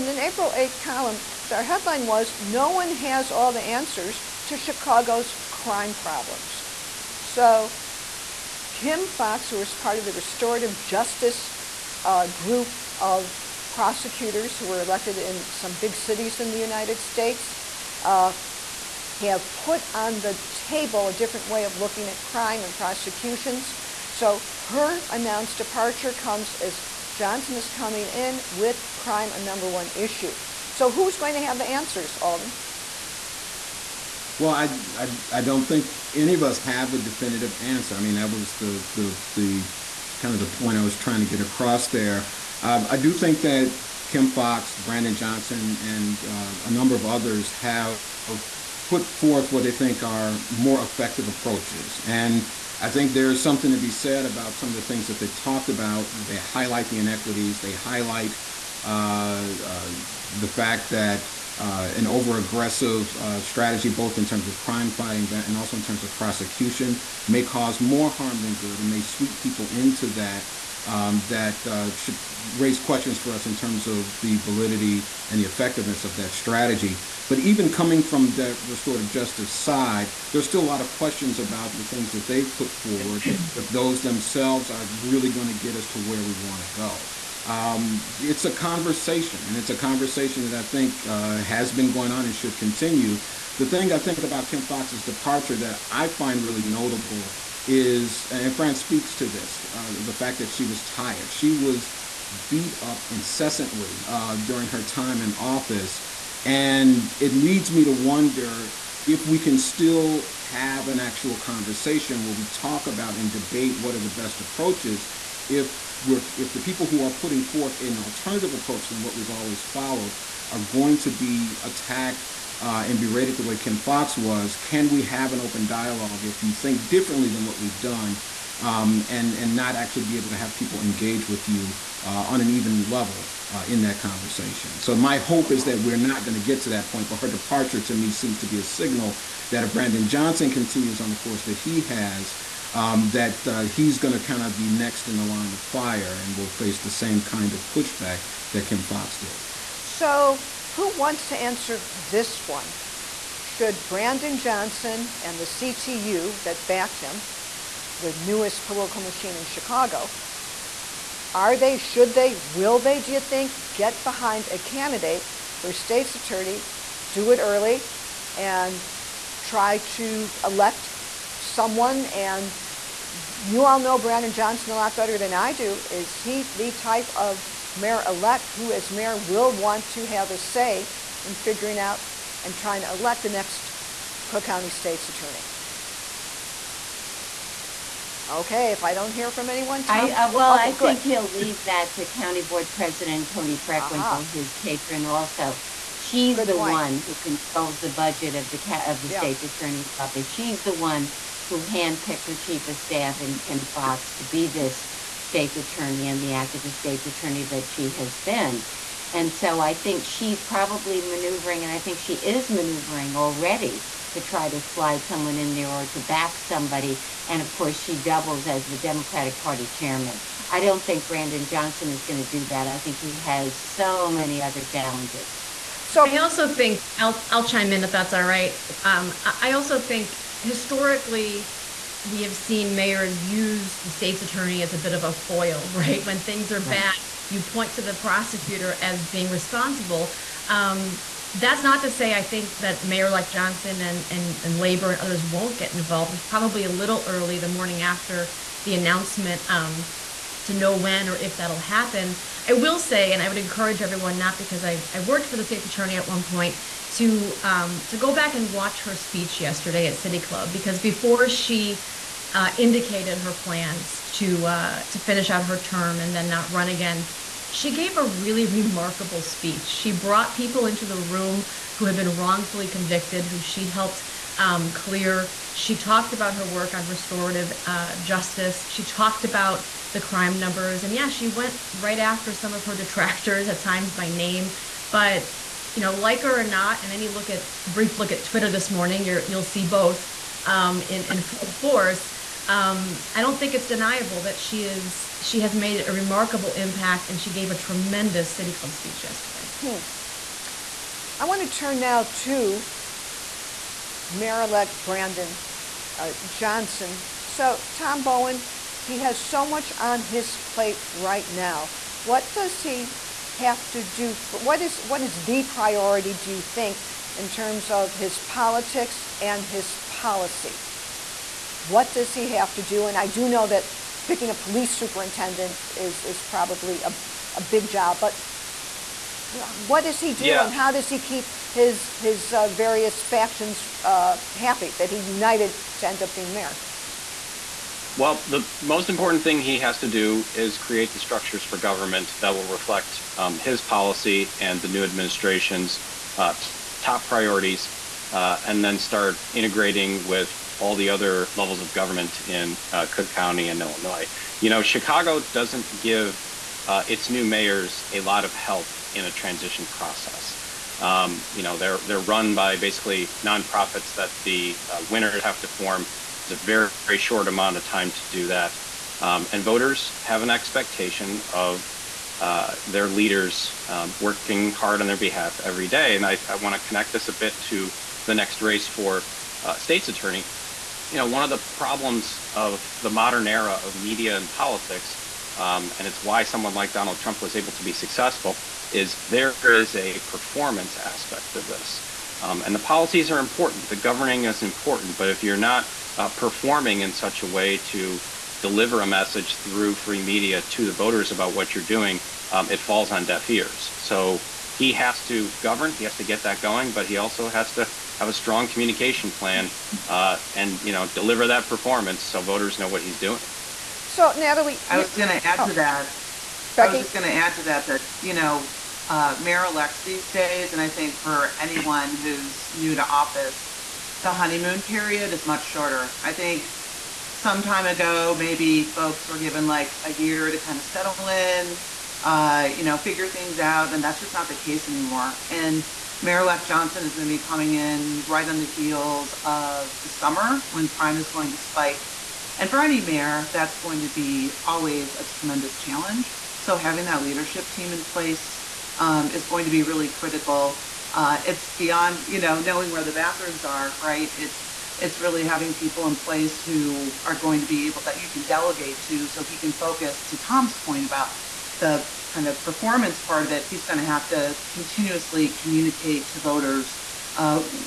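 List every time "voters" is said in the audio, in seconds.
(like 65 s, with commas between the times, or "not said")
369 s, 400 s, 412 s, 466 s.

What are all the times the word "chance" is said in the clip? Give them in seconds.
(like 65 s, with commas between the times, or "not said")
not said.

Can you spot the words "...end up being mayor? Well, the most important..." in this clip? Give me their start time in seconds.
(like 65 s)
335 s.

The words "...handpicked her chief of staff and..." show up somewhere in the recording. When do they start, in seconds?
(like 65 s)
201 s.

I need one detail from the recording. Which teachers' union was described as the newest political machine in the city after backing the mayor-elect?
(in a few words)
CTU.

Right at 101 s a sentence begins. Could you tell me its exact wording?
She was beat up incessantly uh, during her time in office.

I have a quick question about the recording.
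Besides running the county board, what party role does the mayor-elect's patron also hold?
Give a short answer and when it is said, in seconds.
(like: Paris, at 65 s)
Democratic Party chairman, at 218 s.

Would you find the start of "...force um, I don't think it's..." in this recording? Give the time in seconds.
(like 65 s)
291 s.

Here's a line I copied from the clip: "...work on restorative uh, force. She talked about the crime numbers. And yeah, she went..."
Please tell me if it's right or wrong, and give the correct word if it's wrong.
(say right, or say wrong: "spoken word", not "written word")
wrong: "justice", not "force".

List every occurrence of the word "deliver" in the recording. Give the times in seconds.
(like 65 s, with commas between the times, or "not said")
398 s, 410 s.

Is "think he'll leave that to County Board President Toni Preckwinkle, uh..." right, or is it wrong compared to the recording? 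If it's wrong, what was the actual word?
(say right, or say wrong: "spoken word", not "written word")
right.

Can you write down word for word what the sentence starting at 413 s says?
So Natalie, I was going to add oh, to that.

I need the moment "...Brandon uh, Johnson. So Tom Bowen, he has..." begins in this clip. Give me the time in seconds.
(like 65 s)
304 s.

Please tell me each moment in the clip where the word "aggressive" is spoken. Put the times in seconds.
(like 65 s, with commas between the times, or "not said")
62 s.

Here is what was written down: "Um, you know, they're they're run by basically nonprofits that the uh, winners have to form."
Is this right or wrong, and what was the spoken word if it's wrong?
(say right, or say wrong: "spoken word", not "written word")
right.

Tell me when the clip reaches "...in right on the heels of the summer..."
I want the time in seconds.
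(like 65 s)
437 s.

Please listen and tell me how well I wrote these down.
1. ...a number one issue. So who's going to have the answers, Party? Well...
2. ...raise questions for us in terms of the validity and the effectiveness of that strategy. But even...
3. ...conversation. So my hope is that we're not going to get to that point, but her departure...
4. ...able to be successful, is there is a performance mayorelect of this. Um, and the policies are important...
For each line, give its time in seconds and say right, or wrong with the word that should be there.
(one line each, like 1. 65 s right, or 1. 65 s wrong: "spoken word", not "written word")
1. 29 s wrong: "Alden", not "Party"
2. 72 s right
3. 133 s right
4. 387 s wrong: "aspect", not "mayorelect".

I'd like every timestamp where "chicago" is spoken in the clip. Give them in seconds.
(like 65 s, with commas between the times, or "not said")
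4 s, 159 s, 354 s.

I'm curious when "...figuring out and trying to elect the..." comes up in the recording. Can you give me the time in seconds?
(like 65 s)
181 s.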